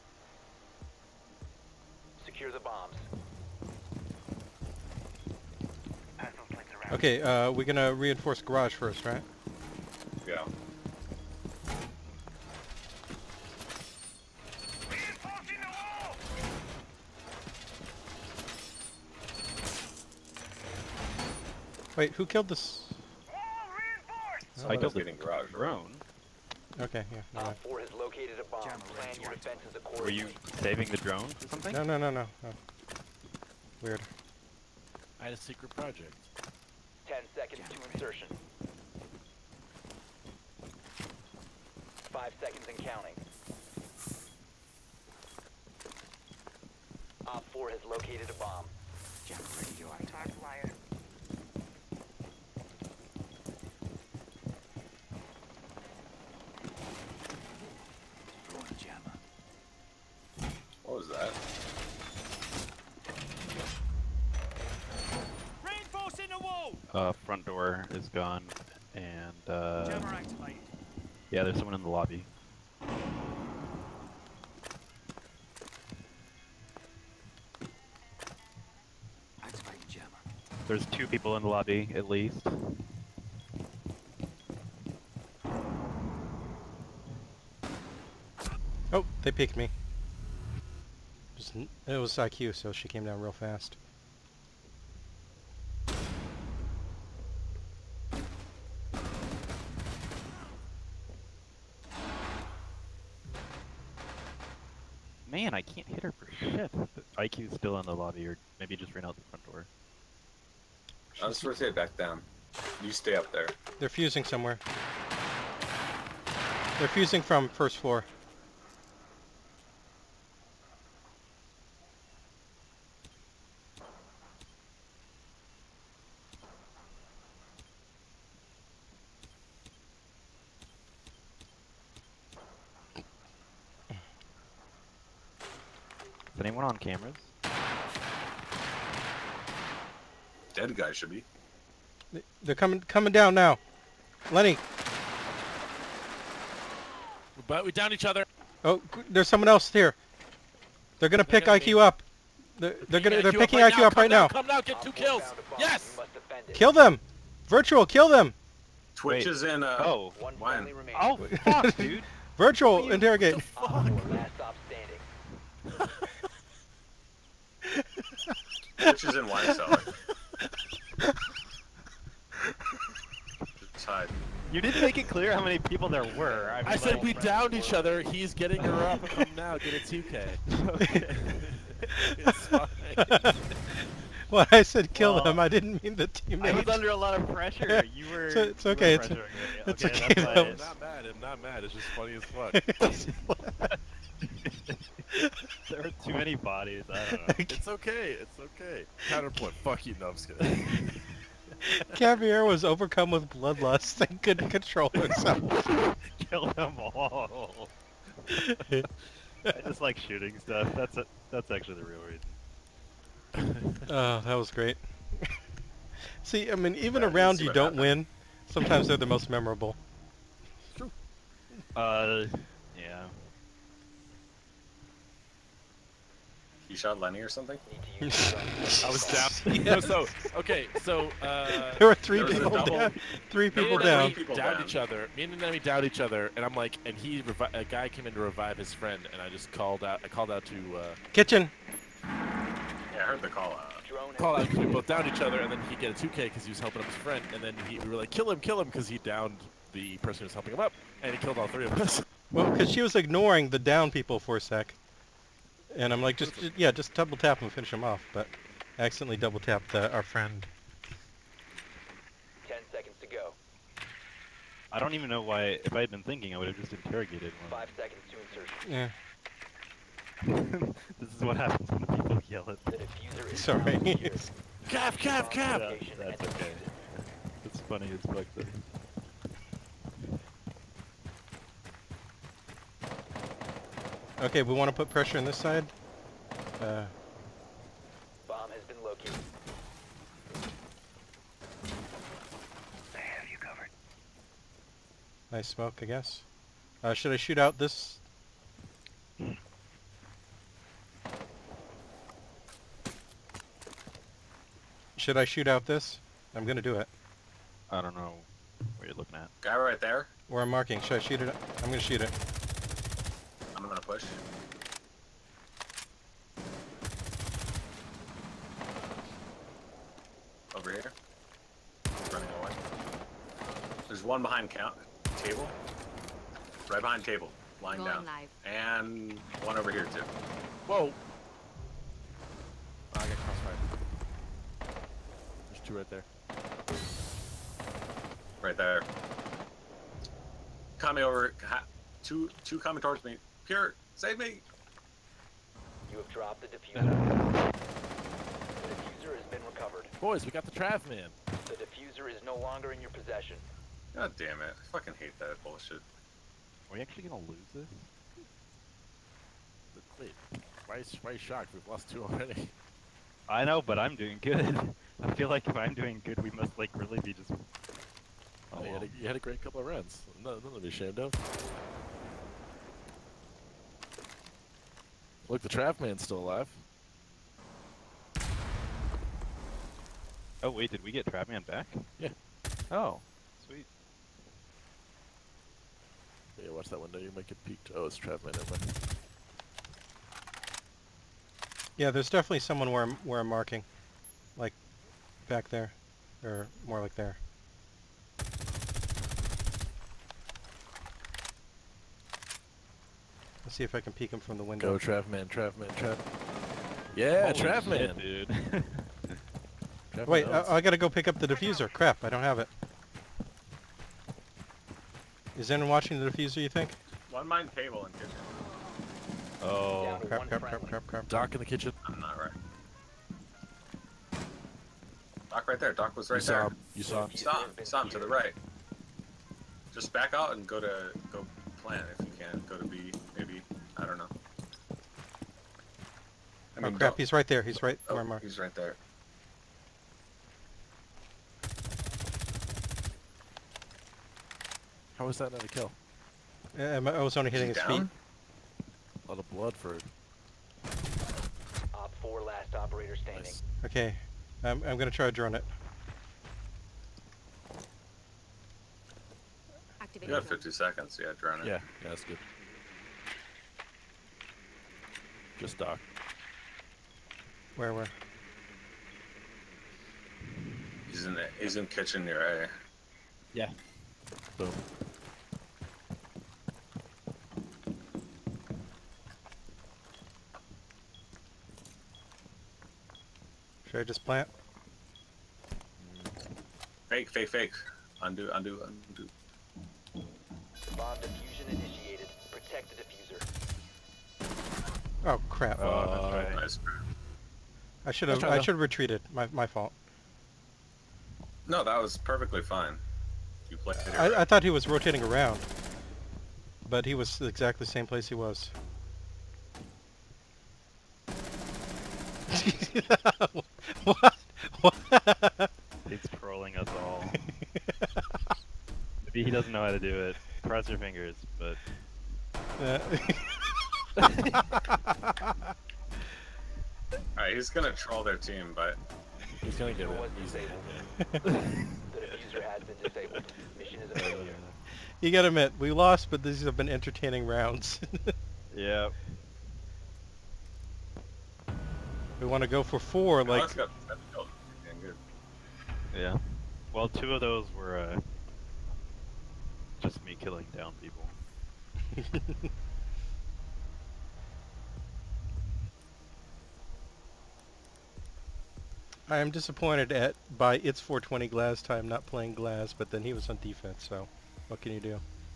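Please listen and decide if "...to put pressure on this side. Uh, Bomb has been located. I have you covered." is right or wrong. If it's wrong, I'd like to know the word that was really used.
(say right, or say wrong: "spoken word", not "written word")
right.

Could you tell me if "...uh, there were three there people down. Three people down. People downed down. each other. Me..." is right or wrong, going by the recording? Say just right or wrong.
right.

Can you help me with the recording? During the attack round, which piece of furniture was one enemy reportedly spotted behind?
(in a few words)
count table.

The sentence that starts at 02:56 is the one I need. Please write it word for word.
I, mean, I like, said we downed each other.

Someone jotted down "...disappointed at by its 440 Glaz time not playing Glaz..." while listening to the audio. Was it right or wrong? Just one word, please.
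wrong.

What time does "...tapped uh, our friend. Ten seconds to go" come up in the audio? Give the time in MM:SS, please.
04:19.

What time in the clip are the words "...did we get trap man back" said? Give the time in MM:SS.
06:20.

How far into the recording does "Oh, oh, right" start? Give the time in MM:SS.
08:15.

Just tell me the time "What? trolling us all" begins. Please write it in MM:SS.
08:34.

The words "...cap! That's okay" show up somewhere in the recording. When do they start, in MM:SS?
04:35.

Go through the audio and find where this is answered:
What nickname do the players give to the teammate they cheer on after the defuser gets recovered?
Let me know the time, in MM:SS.
05:50.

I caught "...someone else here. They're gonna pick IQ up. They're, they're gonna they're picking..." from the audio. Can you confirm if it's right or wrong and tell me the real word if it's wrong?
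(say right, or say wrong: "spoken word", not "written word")
right.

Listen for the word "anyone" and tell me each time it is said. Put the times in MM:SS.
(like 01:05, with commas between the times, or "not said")
02:16, 06:55.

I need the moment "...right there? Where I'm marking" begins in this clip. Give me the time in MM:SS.
05:09.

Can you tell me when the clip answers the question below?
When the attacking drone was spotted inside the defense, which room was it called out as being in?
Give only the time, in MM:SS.
02:49.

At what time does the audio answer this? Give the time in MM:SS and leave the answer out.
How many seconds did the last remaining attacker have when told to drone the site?
07:40.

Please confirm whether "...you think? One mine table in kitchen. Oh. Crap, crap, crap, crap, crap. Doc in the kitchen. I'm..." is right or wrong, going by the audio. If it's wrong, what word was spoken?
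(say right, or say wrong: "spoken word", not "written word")
right.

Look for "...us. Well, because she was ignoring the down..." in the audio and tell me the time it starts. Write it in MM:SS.
04:11.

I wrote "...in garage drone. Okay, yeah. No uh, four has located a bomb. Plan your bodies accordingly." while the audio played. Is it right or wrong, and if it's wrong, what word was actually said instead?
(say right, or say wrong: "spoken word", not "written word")
wrong: "defenses", not "bodies".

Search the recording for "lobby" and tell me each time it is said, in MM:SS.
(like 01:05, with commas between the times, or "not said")
01:11, 01:21.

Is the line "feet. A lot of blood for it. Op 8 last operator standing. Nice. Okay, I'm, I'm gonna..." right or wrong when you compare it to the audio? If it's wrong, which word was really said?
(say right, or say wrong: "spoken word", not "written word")
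wrong: "4", not "8".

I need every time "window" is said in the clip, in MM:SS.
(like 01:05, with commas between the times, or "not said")
06:26, 06:44.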